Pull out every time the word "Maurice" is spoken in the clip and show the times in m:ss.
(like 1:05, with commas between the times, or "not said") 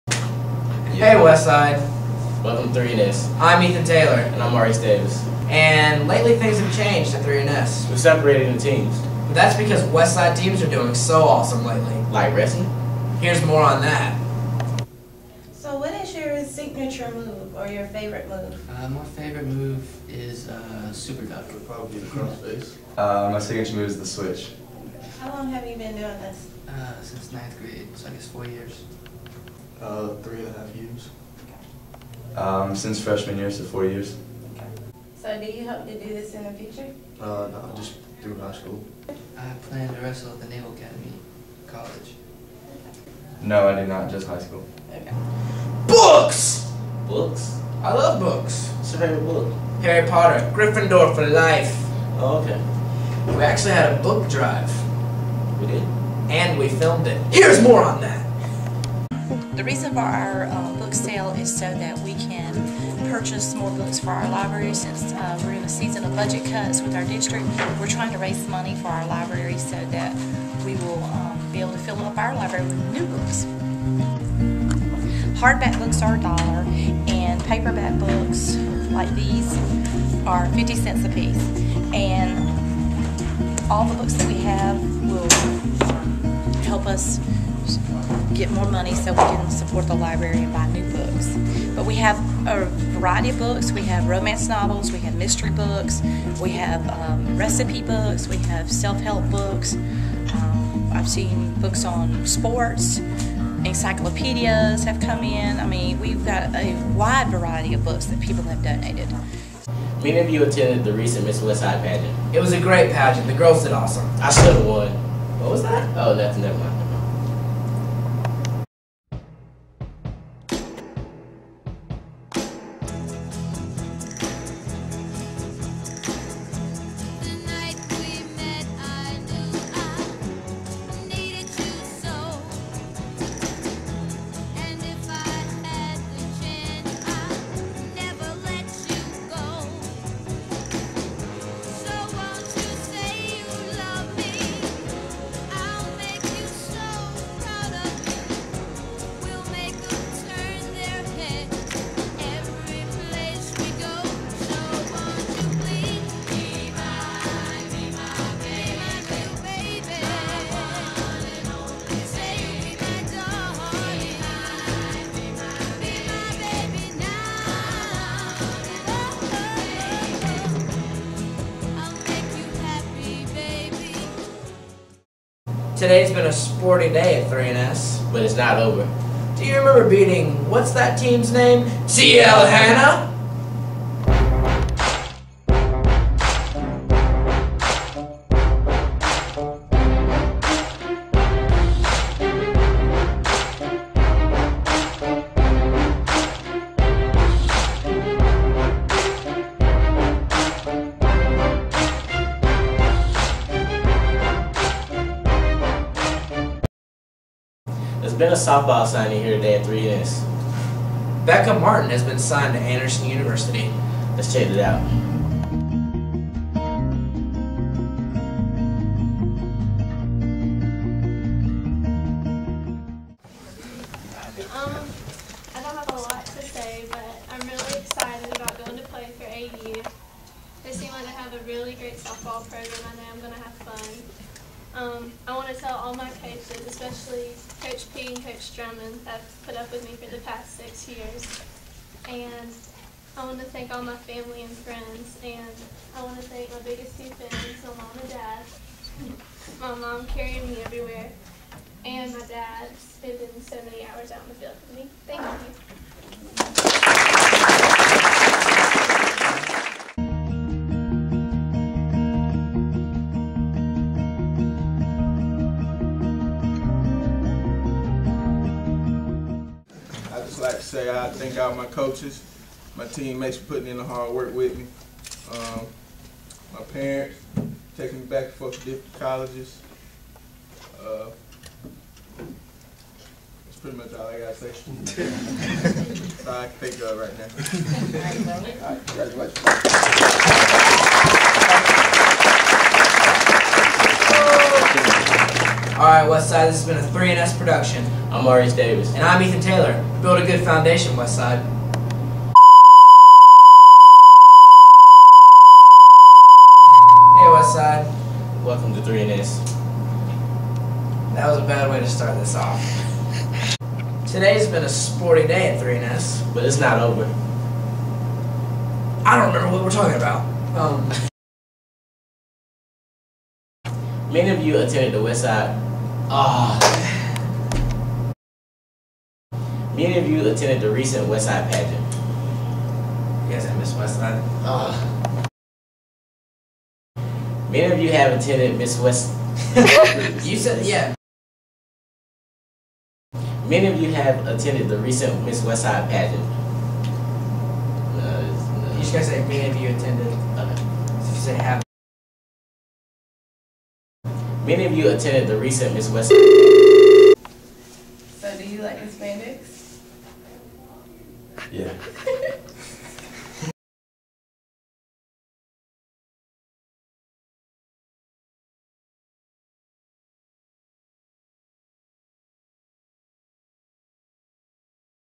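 0:04, 4:58.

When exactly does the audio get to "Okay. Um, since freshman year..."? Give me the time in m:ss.
0:31.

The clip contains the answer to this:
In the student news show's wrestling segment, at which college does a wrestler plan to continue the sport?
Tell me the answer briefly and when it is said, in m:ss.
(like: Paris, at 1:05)
Naval Academy, at 0:40.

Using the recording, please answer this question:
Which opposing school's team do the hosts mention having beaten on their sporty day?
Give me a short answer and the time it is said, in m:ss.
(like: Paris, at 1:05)
T L Hanna, at 3:01.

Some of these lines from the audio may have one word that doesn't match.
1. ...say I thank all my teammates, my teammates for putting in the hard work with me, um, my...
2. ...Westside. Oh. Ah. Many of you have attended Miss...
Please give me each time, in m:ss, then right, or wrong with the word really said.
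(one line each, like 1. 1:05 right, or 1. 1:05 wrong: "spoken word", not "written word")
1. 4:30 wrong: "coaches", not "teammates"
2. 5:33 right.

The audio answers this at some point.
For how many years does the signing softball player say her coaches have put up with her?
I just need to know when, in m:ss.
4:00.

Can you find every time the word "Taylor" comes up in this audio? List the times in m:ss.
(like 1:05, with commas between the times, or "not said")
0:03, 4:59.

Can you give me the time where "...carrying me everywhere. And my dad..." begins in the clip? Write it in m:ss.
4:10.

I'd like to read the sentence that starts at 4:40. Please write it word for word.
Uh, that's pretty much all I got to say.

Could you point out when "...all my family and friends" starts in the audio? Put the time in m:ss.
4:03.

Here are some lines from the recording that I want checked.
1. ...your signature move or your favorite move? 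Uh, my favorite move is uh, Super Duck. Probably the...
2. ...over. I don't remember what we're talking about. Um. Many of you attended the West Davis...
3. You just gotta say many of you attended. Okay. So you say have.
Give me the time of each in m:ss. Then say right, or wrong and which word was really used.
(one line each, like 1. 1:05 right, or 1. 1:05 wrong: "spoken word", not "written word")
1. 0:16 right
2. 5:16 wrong: "Side", not "Davis"
3. 5:48 right.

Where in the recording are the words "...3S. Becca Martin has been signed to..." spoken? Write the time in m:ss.
3:29.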